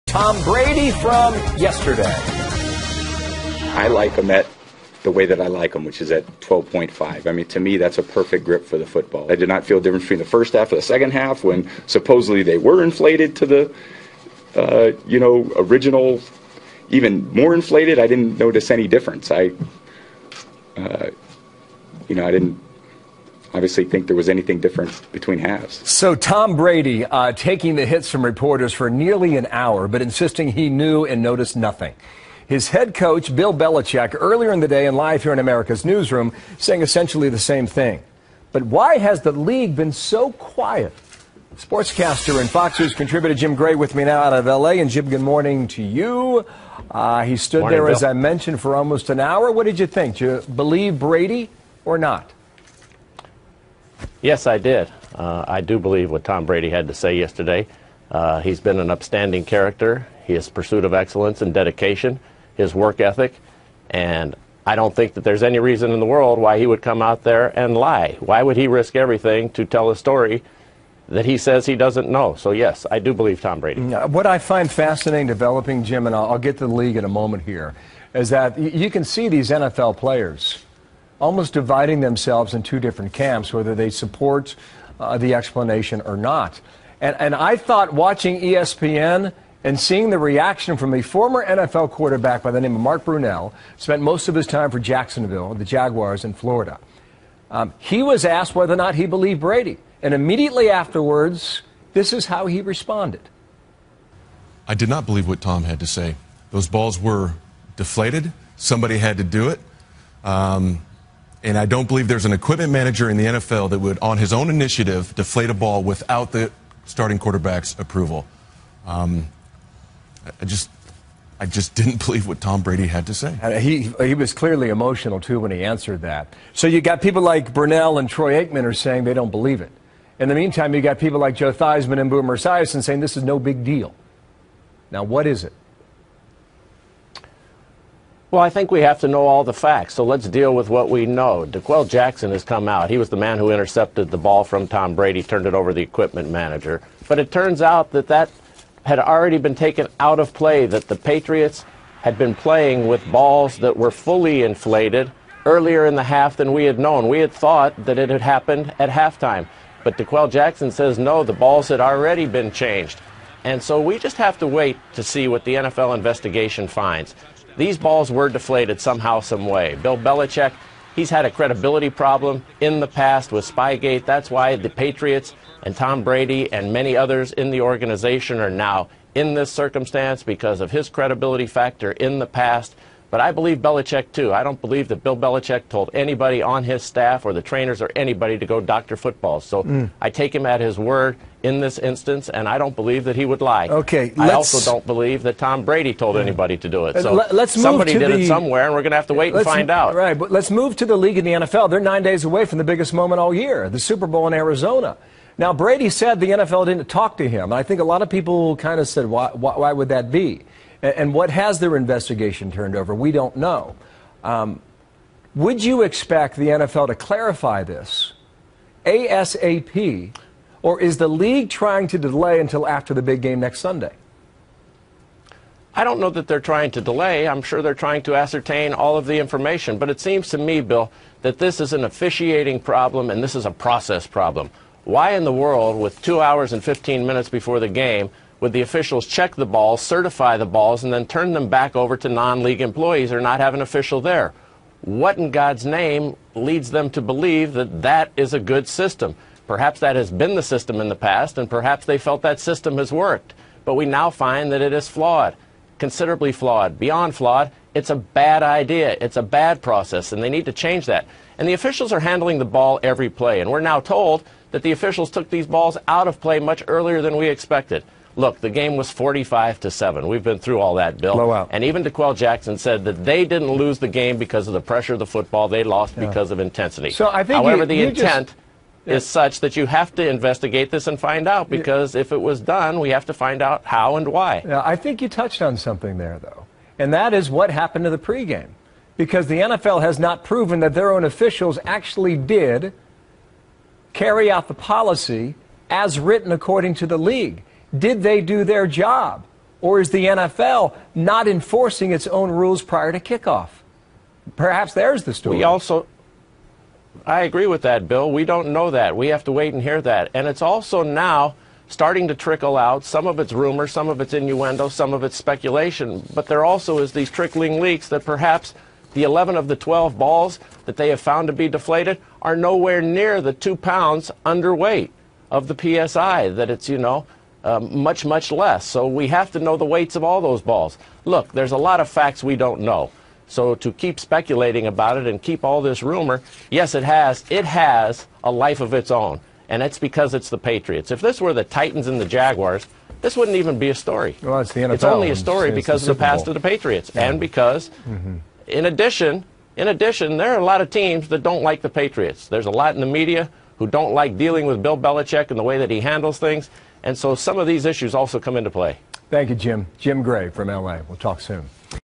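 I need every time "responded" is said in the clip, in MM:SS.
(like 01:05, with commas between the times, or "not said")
01:42.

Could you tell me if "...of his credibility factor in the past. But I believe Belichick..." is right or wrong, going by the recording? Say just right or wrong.
right.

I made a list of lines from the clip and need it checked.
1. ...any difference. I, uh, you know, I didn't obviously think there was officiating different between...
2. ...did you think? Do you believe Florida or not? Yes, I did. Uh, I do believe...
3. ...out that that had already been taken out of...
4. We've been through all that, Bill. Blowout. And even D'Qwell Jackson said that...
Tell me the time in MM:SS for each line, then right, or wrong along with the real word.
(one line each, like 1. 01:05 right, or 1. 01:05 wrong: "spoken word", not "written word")
1. 00:18 wrong: "anything", not "officiating"
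2. 00:49 wrong: "Brady", not "Florida"
3. 02:27 right
4. 04:30 right.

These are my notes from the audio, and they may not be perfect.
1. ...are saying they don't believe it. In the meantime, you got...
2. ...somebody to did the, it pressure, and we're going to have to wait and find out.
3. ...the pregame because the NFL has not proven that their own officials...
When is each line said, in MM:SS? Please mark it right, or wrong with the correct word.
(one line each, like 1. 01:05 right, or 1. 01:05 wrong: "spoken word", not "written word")
1. 02:08 right
2. 03:17 wrong: "somewhere", not "pressure"
3. 04:47 right.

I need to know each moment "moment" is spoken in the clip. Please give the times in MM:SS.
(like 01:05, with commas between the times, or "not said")
01:17, 03:22.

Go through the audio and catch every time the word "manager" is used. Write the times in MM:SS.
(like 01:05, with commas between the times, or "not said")
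01:52, 02:26.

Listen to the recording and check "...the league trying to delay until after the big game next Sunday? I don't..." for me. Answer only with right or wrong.
right.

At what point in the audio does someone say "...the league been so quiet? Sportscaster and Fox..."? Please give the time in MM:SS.
00:39.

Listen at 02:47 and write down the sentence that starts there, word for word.
These balls were deflated somehow, some way.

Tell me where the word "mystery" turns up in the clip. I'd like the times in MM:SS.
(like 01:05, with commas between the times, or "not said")
not said.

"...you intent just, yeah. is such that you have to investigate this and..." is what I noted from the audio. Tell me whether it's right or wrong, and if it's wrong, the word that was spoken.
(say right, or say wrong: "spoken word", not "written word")
right.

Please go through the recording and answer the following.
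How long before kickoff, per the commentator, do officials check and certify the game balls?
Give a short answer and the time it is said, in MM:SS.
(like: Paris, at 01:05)
2 hours 15 minutes, at 03:56.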